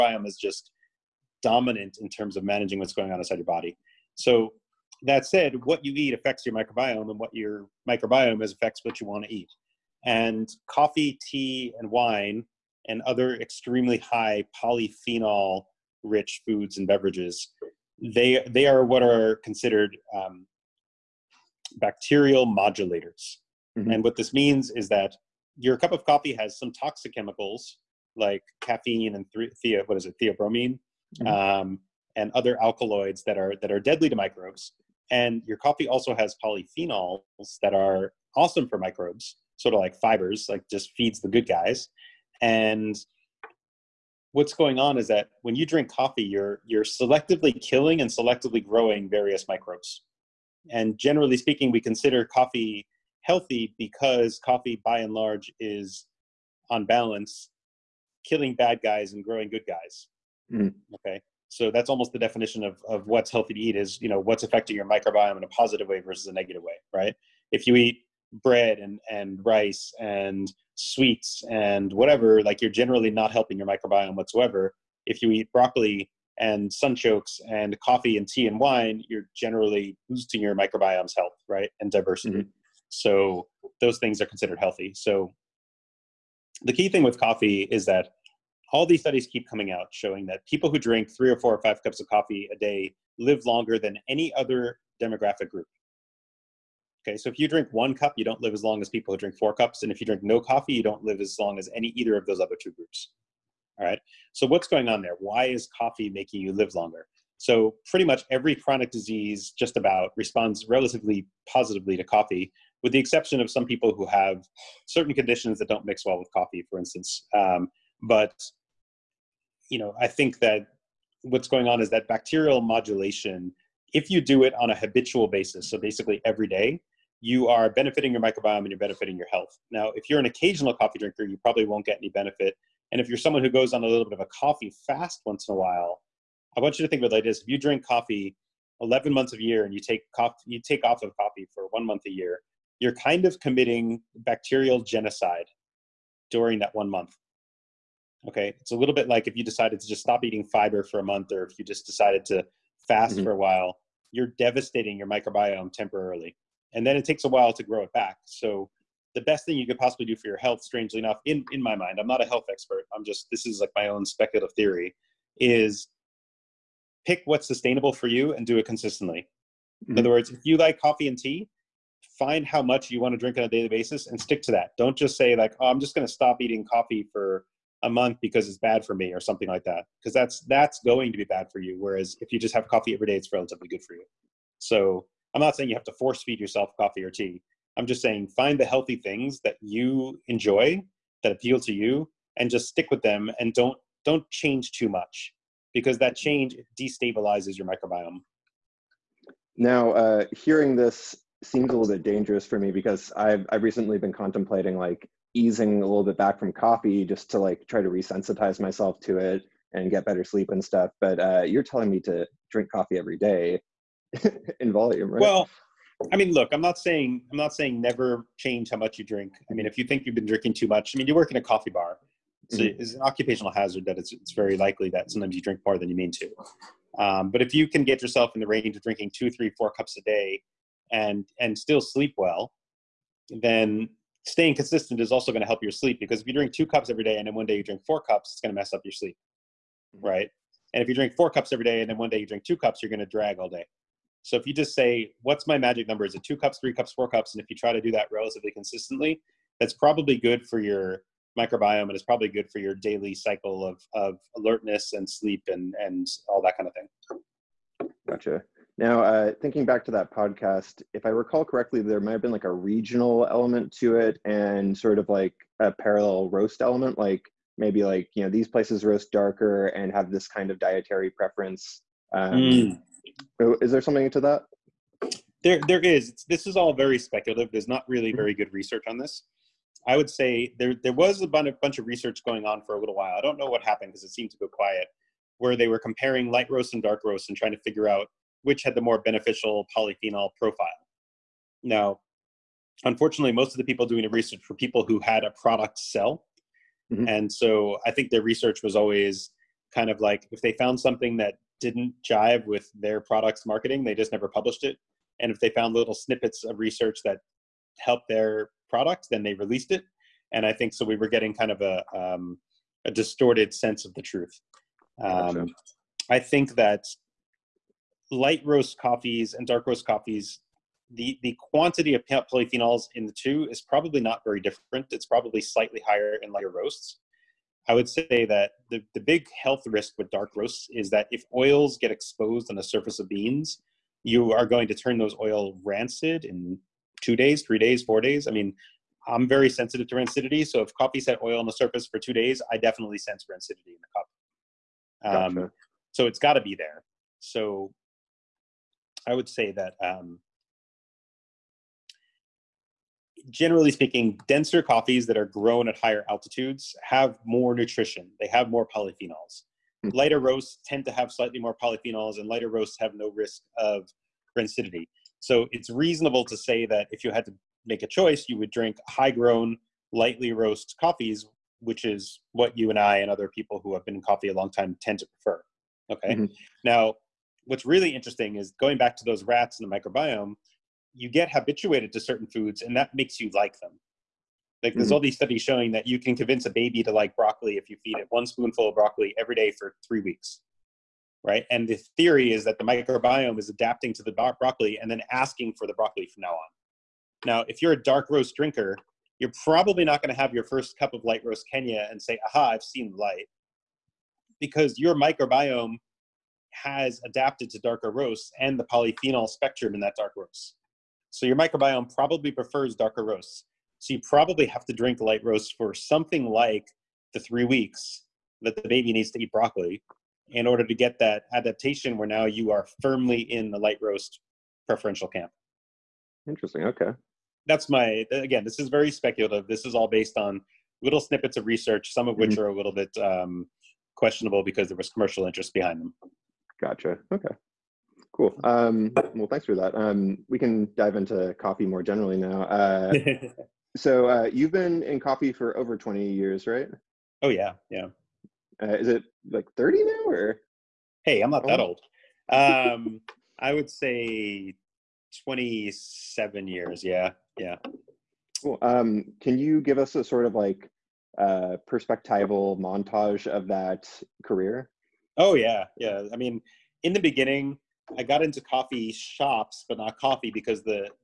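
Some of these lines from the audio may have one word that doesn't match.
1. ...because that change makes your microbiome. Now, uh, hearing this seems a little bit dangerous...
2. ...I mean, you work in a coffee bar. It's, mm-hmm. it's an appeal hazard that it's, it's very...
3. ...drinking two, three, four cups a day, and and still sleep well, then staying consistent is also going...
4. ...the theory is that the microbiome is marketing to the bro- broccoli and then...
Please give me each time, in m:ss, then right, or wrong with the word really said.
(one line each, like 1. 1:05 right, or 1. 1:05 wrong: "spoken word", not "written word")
1. 3:15 wrong: "destabilizes", not "makes"
2. 3:40 wrong: "occupational", not "appeal"
3. 3:48 right
4. 6:31 wrong: "adapting", not "marketing".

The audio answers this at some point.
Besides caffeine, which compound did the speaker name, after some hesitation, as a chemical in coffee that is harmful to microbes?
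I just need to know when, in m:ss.
0:30.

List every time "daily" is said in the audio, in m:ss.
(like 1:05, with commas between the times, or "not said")
2:53, 4:12.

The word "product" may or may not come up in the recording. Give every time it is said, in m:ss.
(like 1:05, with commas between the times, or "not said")
4:55, 5:02, 5:08.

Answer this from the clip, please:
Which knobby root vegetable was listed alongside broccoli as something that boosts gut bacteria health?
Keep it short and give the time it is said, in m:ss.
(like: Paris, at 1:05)
sunchokes, at 1:16.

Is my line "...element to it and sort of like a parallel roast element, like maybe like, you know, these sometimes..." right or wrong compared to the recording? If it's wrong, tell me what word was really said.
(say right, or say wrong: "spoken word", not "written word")
wrong: "places", not "sometimes".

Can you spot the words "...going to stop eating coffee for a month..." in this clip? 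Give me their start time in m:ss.
2:55.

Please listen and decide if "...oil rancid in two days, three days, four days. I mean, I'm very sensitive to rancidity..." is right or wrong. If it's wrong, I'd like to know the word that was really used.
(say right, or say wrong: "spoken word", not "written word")
right.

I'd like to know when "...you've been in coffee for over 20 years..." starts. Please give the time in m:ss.
7:24.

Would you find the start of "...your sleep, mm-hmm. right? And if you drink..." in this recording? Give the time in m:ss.
3:58.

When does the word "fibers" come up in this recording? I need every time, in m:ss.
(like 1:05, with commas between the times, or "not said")
0:39, 2:30.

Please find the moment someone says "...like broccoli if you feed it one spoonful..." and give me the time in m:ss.
6:26.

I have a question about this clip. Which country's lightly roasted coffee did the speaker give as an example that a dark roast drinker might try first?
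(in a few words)
Kenya.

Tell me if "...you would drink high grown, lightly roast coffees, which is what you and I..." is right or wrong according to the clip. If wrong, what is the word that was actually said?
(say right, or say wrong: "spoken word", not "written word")
right.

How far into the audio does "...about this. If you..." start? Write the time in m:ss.
2:17.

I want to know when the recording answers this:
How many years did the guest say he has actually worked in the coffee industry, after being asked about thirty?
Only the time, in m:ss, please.
7:35.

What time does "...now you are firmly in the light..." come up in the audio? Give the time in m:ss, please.
7:02.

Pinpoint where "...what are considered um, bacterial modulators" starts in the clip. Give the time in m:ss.
0:18.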